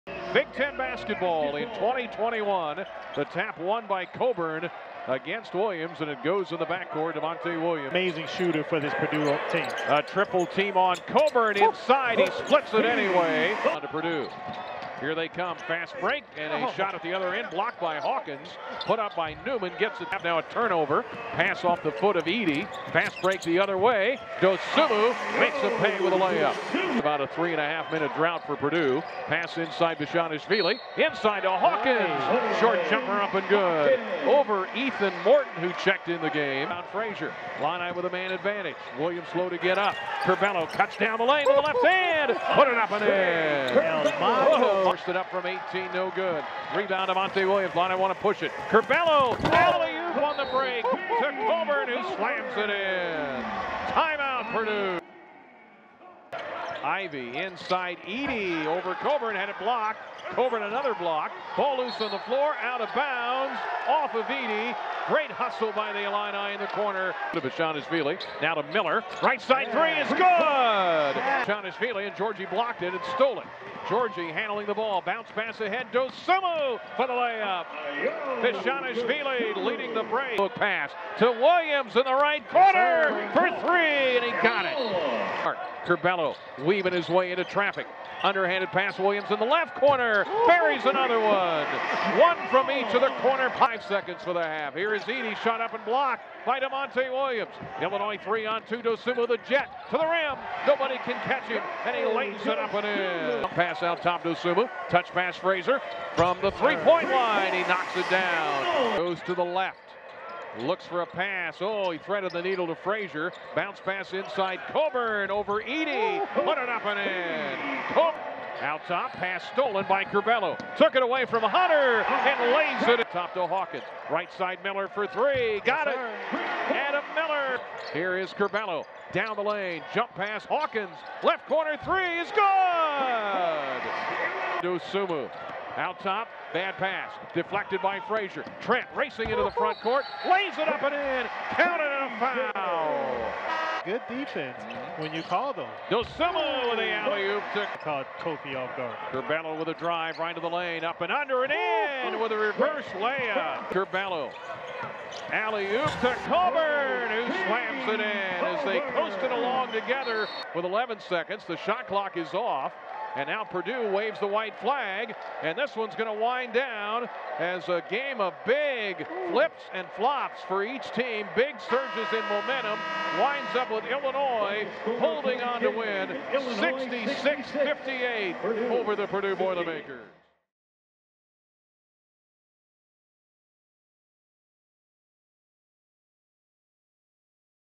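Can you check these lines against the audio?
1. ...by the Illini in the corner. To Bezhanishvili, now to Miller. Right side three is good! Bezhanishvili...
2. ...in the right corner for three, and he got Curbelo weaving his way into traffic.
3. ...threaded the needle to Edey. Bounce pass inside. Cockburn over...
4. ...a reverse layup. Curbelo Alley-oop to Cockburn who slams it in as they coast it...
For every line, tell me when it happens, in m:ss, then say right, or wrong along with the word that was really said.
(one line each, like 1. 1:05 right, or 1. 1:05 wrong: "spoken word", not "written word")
1. 1:05 right
2. 1:21 right
3. 1:51 wrong: "Frazier", not "Edey"
4. 2:32 right.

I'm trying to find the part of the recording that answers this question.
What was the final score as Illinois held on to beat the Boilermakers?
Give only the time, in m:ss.
2:56.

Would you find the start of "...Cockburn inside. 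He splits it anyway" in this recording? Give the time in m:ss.
0:11.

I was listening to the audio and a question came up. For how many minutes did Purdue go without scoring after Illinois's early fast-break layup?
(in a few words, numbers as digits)
3.5.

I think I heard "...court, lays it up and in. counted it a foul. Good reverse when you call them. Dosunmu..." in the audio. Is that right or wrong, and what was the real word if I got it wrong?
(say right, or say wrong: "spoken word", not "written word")
wrong: "defense", not "reverse".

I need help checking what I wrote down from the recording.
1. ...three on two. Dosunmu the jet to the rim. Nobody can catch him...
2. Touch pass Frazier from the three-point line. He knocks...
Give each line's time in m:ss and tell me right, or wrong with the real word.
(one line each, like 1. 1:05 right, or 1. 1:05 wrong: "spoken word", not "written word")
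1. 1:38 right
2. 1:44 right.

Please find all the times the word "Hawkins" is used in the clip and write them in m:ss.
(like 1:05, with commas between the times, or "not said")
0:17, 0:31, 2:03, 2:10.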